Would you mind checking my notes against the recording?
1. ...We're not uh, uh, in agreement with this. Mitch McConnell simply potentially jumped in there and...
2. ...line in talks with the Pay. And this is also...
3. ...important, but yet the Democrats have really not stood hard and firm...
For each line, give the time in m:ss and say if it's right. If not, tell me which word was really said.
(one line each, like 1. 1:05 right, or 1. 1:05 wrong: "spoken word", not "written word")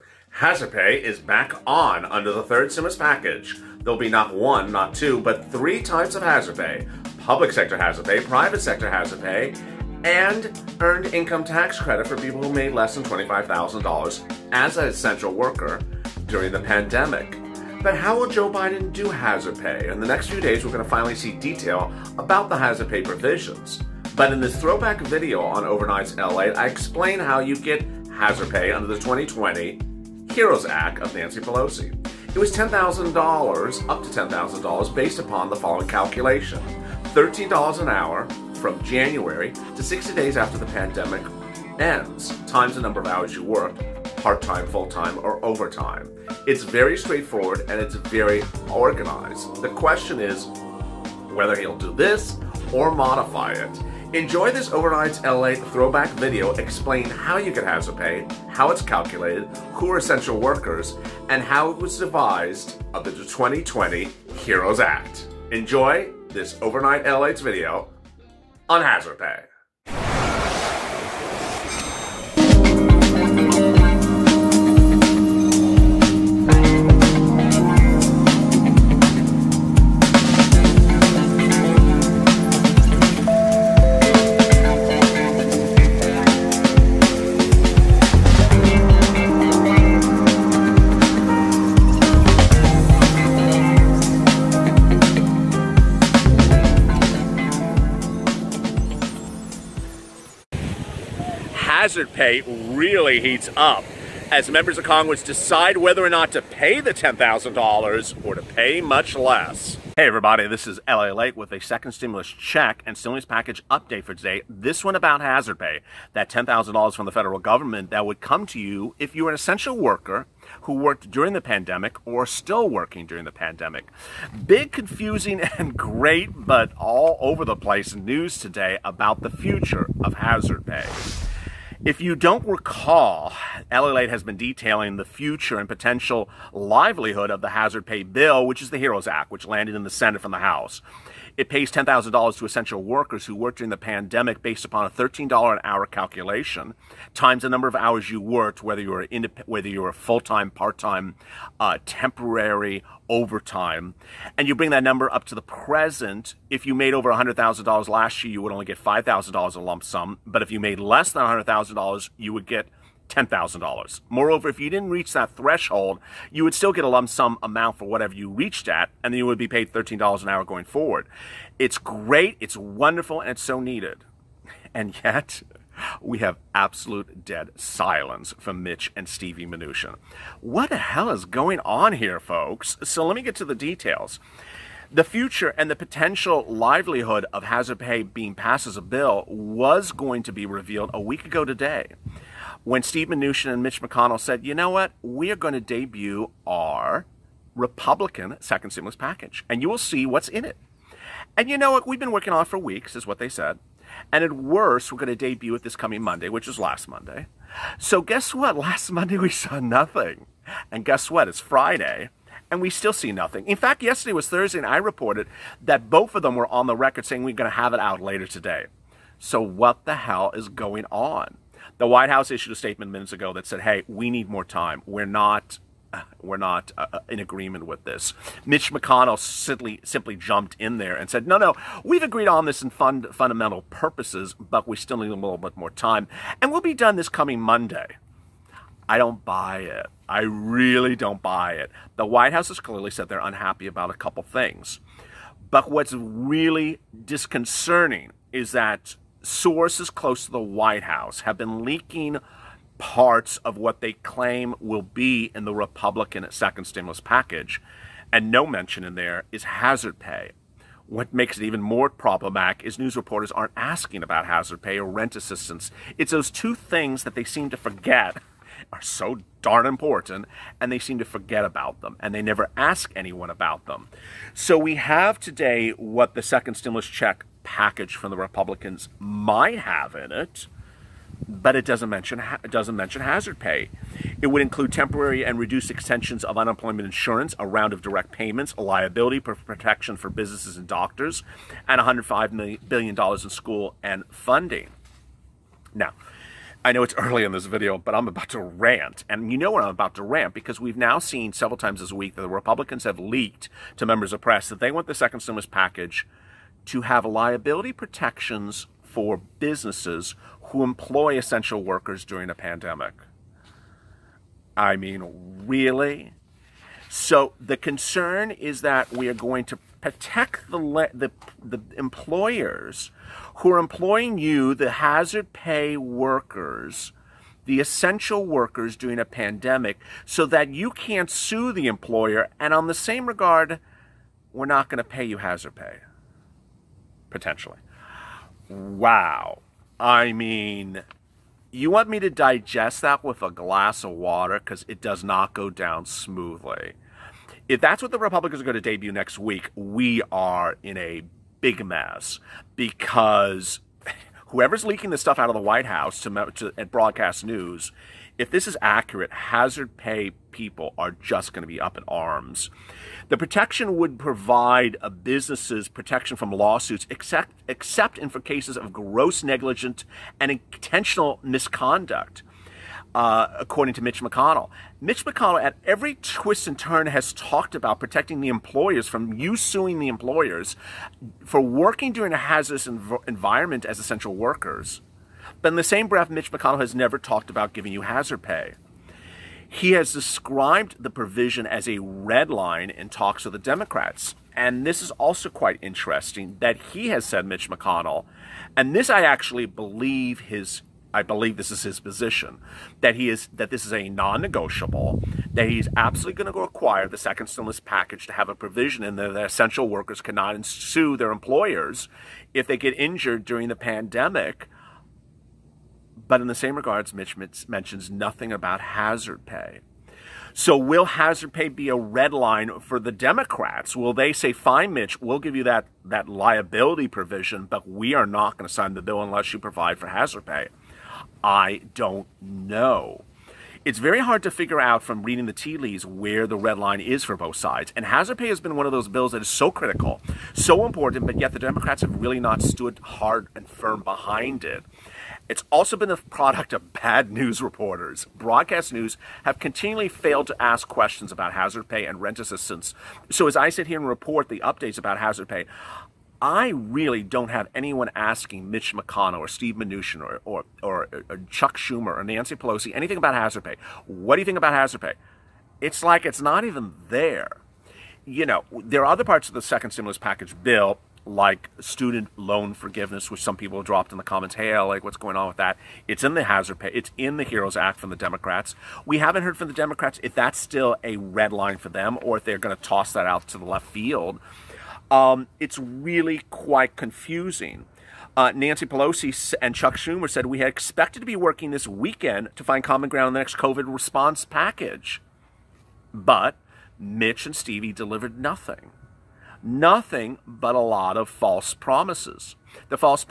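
1. 3:46 wrong: "simply", not "potentially"
2. 6:32 wrong: "Democrats", not "Pay"
3. 7:20 right.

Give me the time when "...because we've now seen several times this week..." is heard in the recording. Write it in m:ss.
5:00.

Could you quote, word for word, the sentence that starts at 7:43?
What do you think about hazard pay?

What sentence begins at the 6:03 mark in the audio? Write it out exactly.
The protection would provide businesses protection from lawsuits, except, except in for cases of gross negligence and intentional misconduct.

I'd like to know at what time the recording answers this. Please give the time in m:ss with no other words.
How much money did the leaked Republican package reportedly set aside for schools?
4:51.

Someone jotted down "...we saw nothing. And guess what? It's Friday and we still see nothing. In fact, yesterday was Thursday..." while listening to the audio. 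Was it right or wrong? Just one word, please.
right.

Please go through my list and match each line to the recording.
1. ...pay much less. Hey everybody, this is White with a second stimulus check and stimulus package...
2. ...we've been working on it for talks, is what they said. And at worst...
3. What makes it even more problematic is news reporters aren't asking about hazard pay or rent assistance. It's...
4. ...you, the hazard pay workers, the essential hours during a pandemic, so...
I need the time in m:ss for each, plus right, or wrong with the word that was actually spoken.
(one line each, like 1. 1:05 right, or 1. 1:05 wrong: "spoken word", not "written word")
1. 1:48 wrong: "LALATE", not "White"
2. 3:21 wrong: "weeks", not "talks"
3. 4:20 right
4. 5:24 wrong: "workers", not "hours".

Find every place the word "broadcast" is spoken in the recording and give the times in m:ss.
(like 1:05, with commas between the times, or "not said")
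5:56, 7:28.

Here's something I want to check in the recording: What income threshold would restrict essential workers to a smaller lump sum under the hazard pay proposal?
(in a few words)
$100,000.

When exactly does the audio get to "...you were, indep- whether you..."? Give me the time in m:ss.
2:28.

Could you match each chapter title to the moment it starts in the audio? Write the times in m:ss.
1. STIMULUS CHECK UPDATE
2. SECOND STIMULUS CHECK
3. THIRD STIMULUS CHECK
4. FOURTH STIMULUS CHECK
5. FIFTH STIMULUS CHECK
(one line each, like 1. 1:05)
1. 0:59
2. 1:59
3. 2:59
4. 3:59
5. 4:59.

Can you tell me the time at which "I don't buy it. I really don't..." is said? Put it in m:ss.
3:58.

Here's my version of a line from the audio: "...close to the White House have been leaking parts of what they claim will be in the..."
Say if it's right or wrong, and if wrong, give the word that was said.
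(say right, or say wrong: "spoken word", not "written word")
right.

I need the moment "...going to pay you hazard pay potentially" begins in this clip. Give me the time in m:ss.
5:34.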